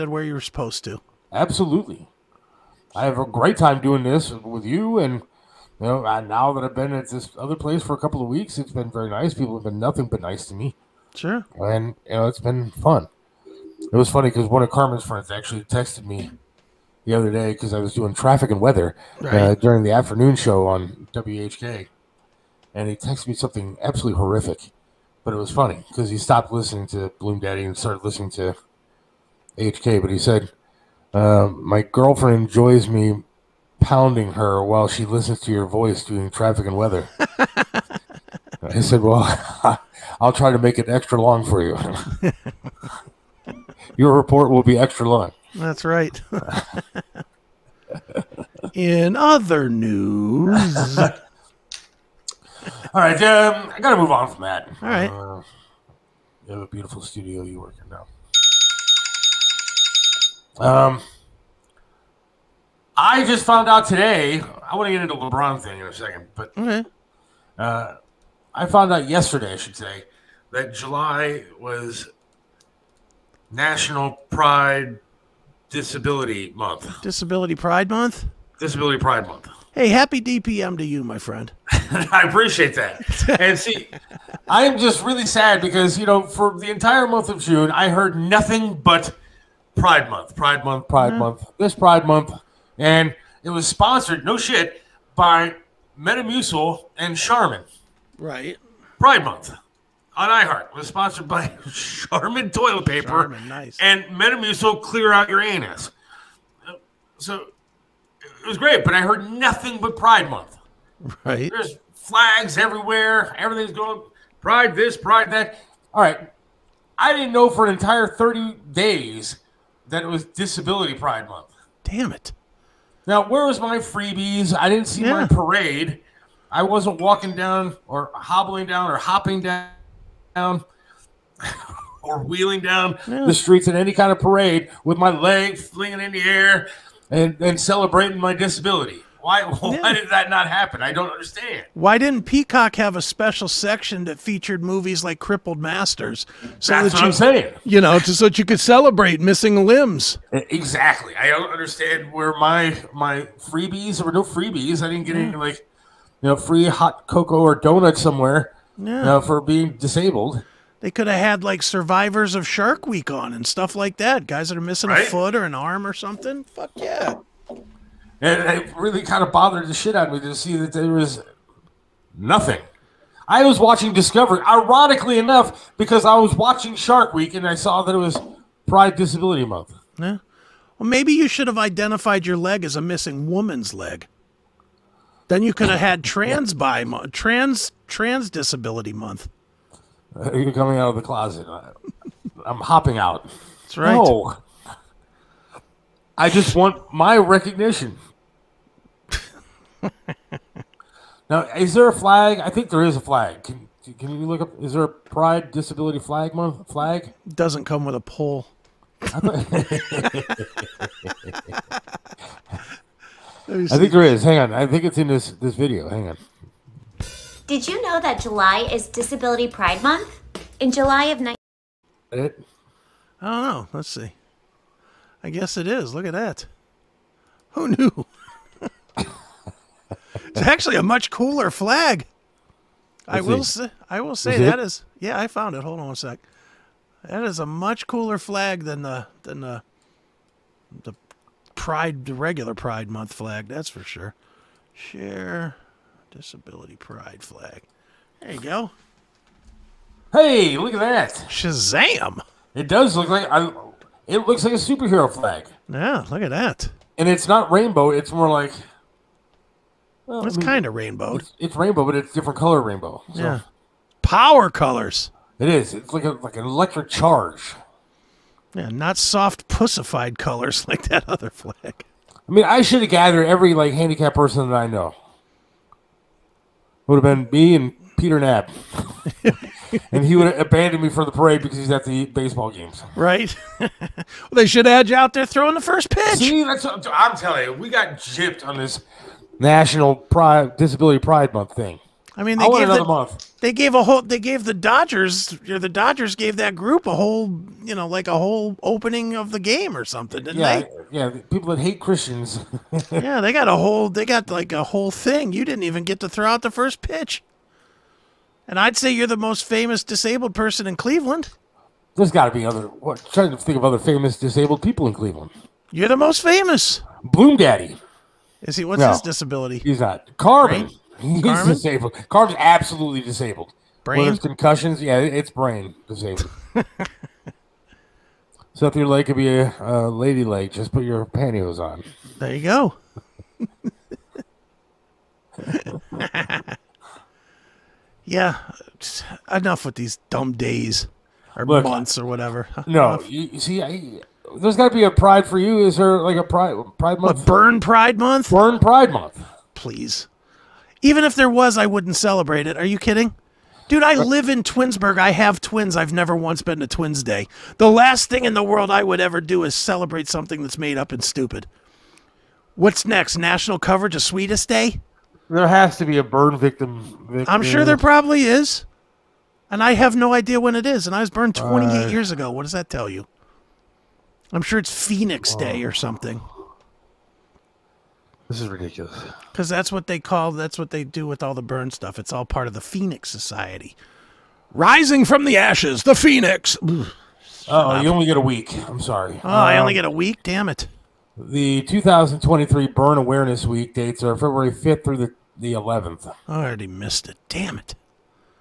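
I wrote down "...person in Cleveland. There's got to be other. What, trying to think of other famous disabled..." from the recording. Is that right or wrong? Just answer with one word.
right.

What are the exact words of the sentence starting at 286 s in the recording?
See, that's what I'm telling you.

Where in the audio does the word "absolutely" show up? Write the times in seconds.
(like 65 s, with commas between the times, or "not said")
1 s, 23 s, 322 s.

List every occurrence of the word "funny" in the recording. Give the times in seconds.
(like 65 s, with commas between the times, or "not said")
14 s, 25 s.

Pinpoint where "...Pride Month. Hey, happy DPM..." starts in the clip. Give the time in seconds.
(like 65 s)
78 s.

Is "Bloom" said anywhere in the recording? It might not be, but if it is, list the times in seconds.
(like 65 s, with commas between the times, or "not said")
27 s, 317 s.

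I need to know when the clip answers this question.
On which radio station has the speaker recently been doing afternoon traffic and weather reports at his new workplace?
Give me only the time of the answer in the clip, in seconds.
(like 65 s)
21 s.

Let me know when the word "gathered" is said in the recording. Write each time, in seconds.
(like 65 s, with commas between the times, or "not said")
272 s.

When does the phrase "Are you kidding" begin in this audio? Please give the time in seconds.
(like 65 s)
352 s.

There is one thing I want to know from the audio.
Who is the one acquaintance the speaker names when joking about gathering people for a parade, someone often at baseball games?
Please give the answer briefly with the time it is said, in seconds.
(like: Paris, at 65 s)
Peter Knapp, at 277 s.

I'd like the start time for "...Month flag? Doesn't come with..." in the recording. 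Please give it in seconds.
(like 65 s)
206 s.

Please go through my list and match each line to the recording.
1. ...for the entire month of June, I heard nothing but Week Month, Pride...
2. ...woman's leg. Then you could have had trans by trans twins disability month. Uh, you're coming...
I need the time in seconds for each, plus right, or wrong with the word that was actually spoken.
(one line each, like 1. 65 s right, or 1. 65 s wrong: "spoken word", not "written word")
1. 86 s wrong: "Pride", not "Week"
2. 183 s wrong: "trans", not "twins".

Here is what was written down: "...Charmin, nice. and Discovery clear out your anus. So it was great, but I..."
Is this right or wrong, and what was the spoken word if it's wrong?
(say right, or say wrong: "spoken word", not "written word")
wrong: "Metamucil", not "Discovery".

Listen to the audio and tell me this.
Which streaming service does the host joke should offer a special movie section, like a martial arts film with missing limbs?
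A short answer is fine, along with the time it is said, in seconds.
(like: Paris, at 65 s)
Peacock, at 142 s.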